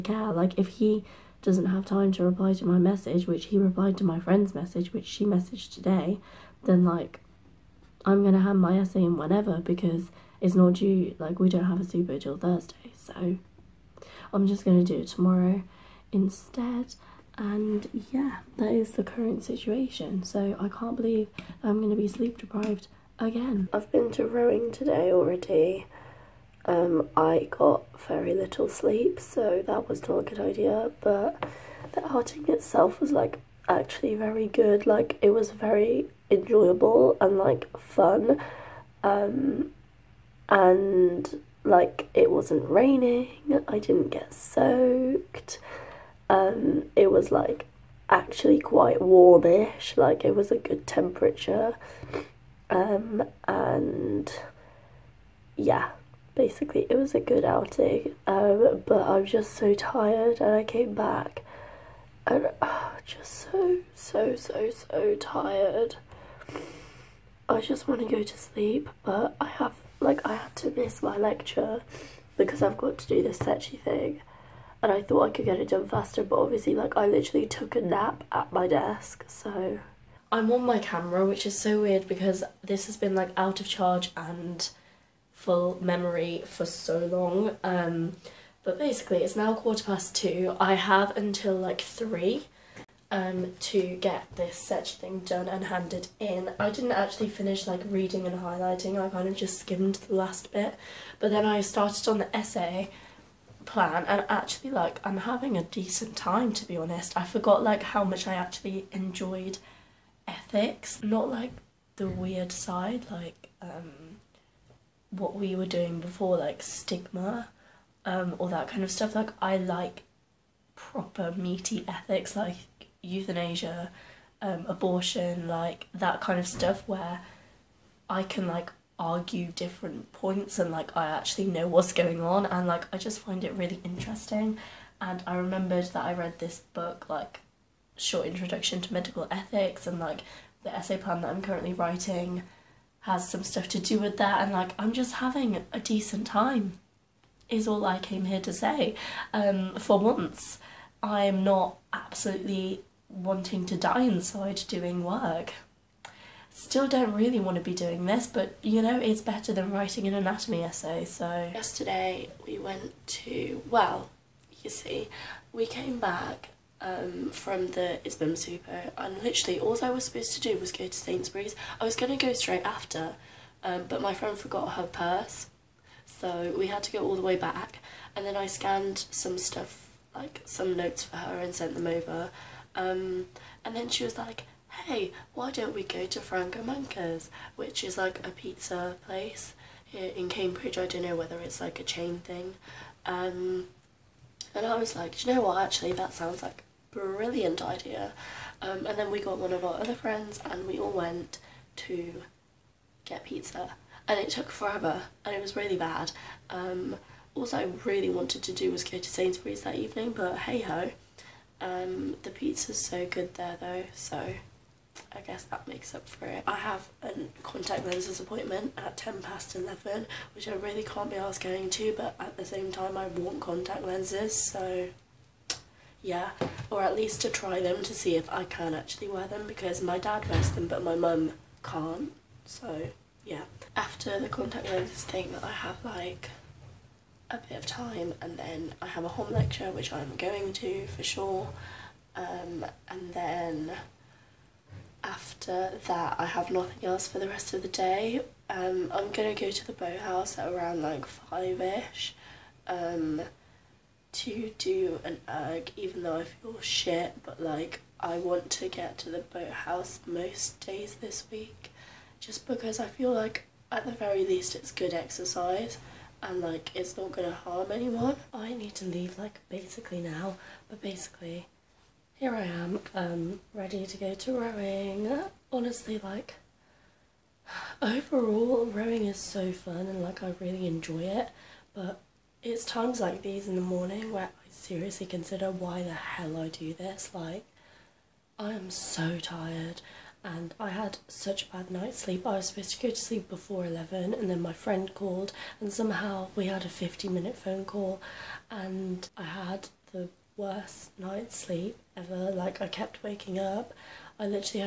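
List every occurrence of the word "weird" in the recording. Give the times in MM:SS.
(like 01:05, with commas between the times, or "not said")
01:21, 01:52.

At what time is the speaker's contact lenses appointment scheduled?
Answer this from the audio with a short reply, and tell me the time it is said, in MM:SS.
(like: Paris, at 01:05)
11:10, at 03:38.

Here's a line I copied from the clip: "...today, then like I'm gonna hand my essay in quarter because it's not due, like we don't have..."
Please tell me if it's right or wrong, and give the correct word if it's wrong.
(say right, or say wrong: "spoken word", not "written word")
wrong: "whenever", not "quarter".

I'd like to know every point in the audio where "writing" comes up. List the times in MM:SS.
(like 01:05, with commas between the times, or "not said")
02:21, 02:39.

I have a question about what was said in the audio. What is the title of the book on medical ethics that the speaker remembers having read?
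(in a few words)
Short Introduction to Medical Ethics.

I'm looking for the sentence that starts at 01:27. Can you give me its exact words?
Um, but basically, it's now quarter past two.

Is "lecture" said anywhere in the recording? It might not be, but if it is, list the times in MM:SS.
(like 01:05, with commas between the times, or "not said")
01:11, 03:59.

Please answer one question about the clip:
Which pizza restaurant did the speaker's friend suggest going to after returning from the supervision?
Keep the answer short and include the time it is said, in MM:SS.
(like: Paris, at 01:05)
Franco Manca's, at 03:06.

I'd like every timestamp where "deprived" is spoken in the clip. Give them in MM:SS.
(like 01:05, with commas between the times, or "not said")
00:22.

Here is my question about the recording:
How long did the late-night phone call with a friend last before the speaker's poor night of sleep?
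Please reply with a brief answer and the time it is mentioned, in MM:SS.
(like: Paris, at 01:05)
50 minutes, at 04:56.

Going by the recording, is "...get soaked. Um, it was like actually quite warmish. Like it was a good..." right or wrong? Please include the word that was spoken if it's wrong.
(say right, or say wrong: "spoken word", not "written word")
right.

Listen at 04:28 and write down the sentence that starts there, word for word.
I need to leave like basically now, but basically here I am, um, ready to go to rowing.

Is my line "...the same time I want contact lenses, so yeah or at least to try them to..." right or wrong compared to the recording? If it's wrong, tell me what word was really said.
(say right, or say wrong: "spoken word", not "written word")
right.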